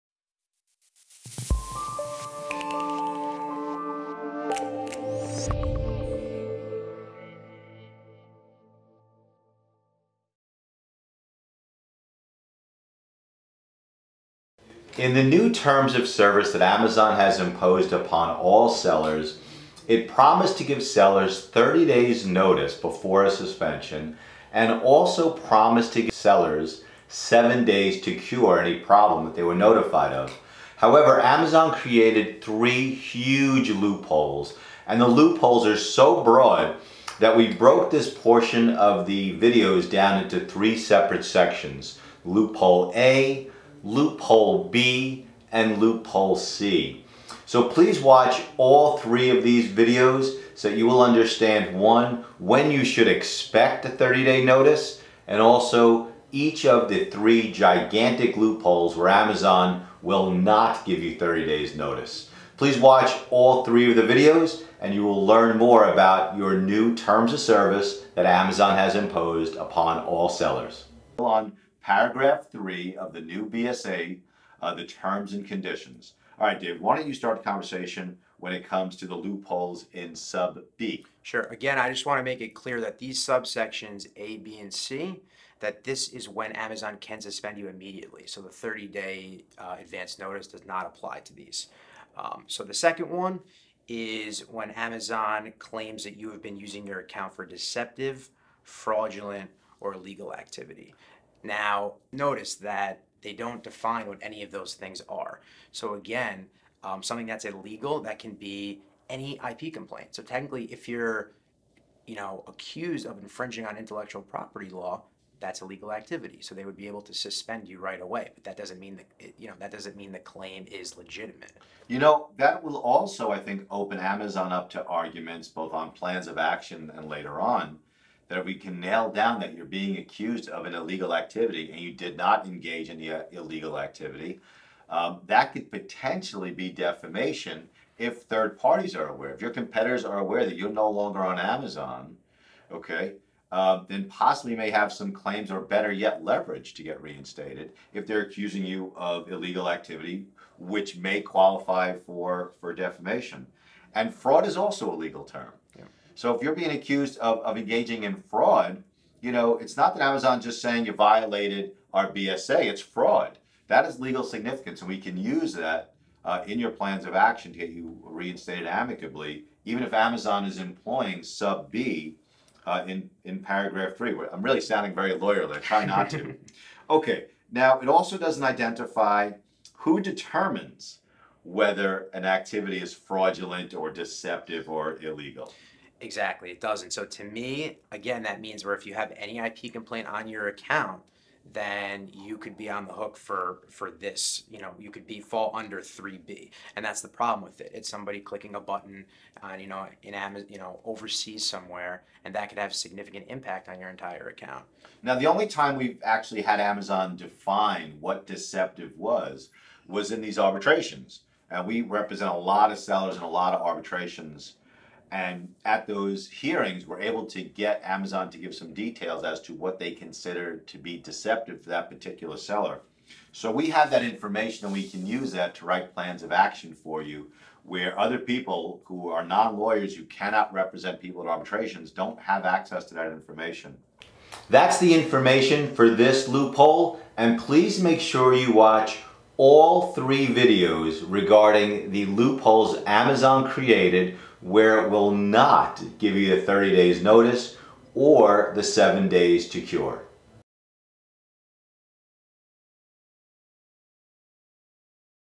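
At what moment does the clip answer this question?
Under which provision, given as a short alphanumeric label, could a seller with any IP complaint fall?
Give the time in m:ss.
3:15.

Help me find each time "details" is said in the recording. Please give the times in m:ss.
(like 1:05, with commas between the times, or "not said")
3:38.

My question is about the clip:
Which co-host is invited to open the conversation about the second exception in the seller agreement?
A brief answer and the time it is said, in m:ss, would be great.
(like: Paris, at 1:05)
Dave, at 1:16.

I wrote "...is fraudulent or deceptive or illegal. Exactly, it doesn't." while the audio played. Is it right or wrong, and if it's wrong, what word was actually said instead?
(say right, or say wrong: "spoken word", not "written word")
right.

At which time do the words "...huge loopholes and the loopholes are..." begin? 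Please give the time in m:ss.
0:32.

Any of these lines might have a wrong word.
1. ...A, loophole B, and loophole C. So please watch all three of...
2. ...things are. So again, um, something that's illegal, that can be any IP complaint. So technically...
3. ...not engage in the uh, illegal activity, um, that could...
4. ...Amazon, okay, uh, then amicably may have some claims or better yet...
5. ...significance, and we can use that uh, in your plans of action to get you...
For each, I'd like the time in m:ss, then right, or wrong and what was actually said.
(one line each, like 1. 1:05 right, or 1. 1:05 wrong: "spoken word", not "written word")
1. 0:42 right
2. 1:44 right
3. 2:12 right
4. 2:21 wrong: "possibly", not "amicably"
5. 2:44 right.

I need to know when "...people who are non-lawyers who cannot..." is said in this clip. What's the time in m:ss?
3:48.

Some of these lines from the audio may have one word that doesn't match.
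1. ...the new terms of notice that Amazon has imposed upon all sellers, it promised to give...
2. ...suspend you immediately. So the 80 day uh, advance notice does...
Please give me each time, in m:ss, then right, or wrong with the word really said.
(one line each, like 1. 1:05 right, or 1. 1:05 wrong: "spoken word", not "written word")
1. 0:15 wrong: "service", not "notice"
2. 1:27 wrong: "30", not "80".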